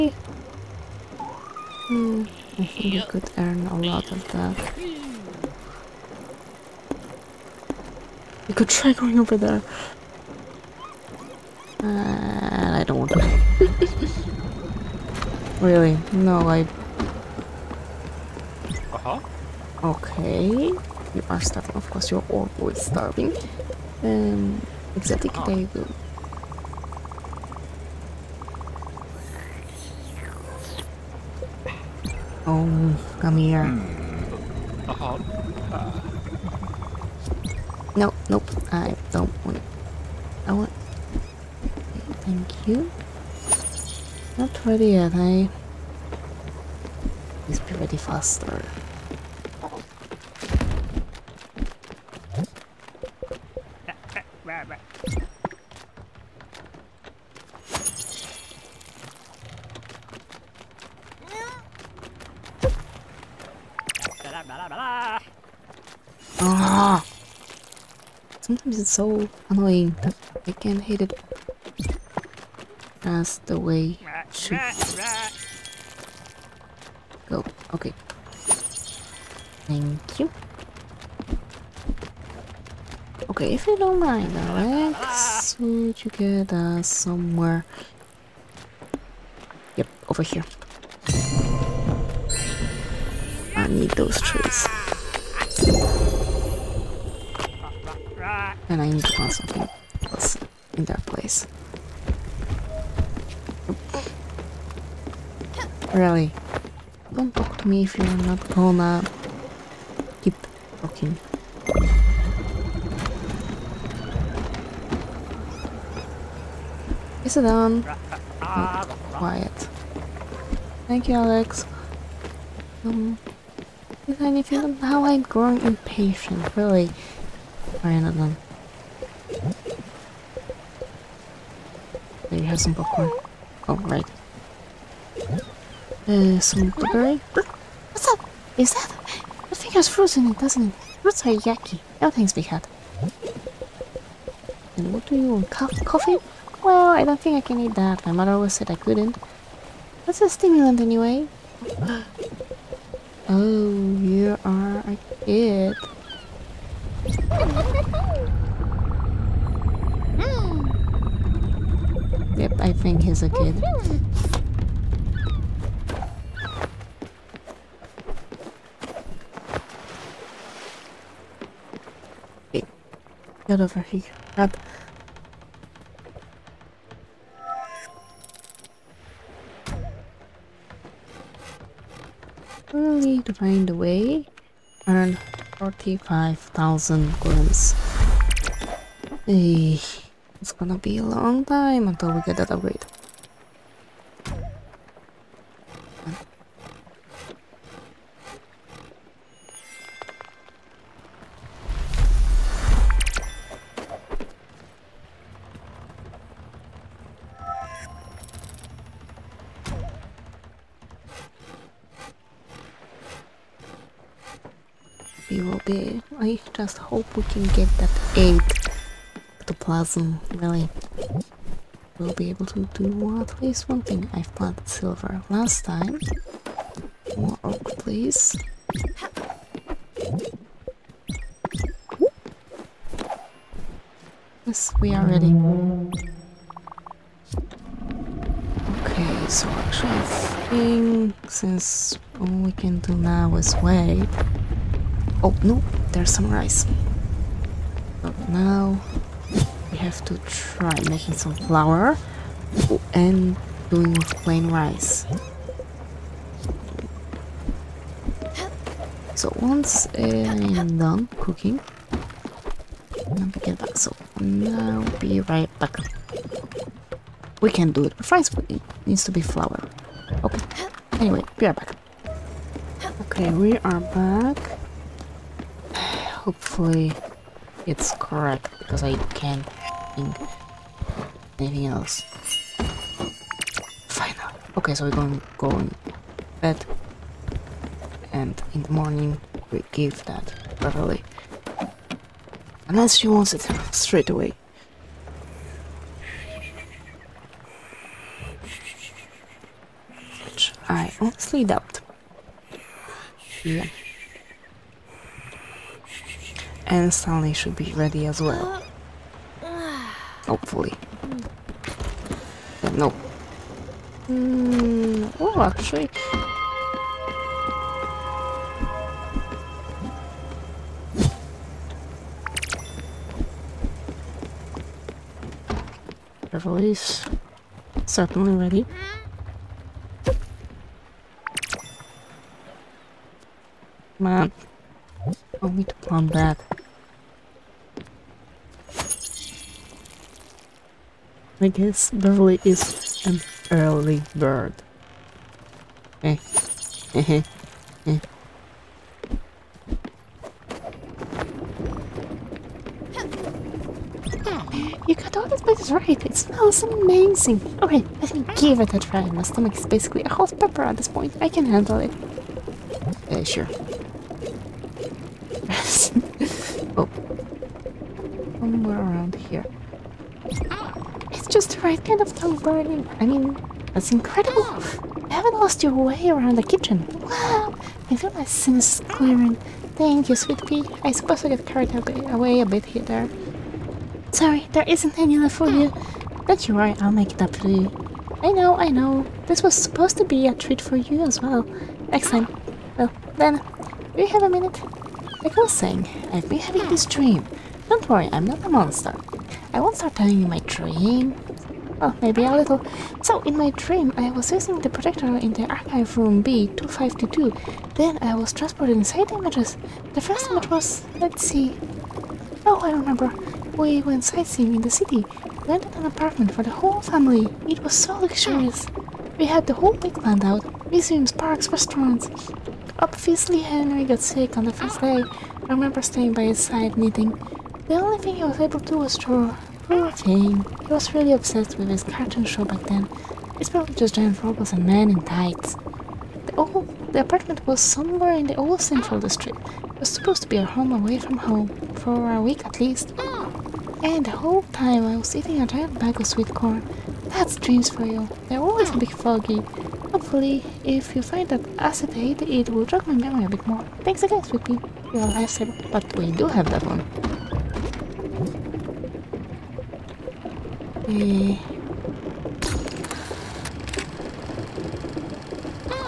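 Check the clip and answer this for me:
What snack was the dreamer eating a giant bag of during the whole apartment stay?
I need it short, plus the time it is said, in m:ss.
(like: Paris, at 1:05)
sweet corn, at 7:26.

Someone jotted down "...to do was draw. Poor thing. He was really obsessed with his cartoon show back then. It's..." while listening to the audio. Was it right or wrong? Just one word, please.
right.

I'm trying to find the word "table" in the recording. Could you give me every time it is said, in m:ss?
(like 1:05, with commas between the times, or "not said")
0:25.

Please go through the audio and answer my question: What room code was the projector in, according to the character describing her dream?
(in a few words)
B252.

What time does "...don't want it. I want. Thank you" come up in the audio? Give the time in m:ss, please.
0:39.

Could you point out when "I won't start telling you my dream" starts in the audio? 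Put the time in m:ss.
6:39.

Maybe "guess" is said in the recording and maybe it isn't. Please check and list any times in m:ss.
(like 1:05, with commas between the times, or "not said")
5:41.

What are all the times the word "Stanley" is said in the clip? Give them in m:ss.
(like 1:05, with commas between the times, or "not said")
5:06.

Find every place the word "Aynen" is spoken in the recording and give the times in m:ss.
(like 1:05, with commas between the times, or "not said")
2:07.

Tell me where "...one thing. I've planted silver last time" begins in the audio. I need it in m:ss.
3:43.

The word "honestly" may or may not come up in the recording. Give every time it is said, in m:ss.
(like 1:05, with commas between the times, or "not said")
5:01.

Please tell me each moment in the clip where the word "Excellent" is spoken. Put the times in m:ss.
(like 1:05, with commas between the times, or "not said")
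6:31.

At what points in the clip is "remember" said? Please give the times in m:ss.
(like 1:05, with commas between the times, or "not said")
6:52, 7:05.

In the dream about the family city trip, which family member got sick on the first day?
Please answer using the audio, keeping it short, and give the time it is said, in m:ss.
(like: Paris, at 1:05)
Henry, at 7:03.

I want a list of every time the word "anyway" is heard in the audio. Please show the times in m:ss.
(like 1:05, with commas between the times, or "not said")
2:30, 4:31.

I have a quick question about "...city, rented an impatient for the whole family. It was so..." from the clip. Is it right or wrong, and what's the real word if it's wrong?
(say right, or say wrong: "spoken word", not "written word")
wrong: "apartment", not "impatient".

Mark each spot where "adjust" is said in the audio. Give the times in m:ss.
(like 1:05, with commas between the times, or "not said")
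not said.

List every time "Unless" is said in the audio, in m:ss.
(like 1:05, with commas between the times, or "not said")
4:52.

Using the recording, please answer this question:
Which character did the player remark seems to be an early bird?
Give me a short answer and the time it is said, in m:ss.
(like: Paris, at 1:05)
Beverly, at 5:41.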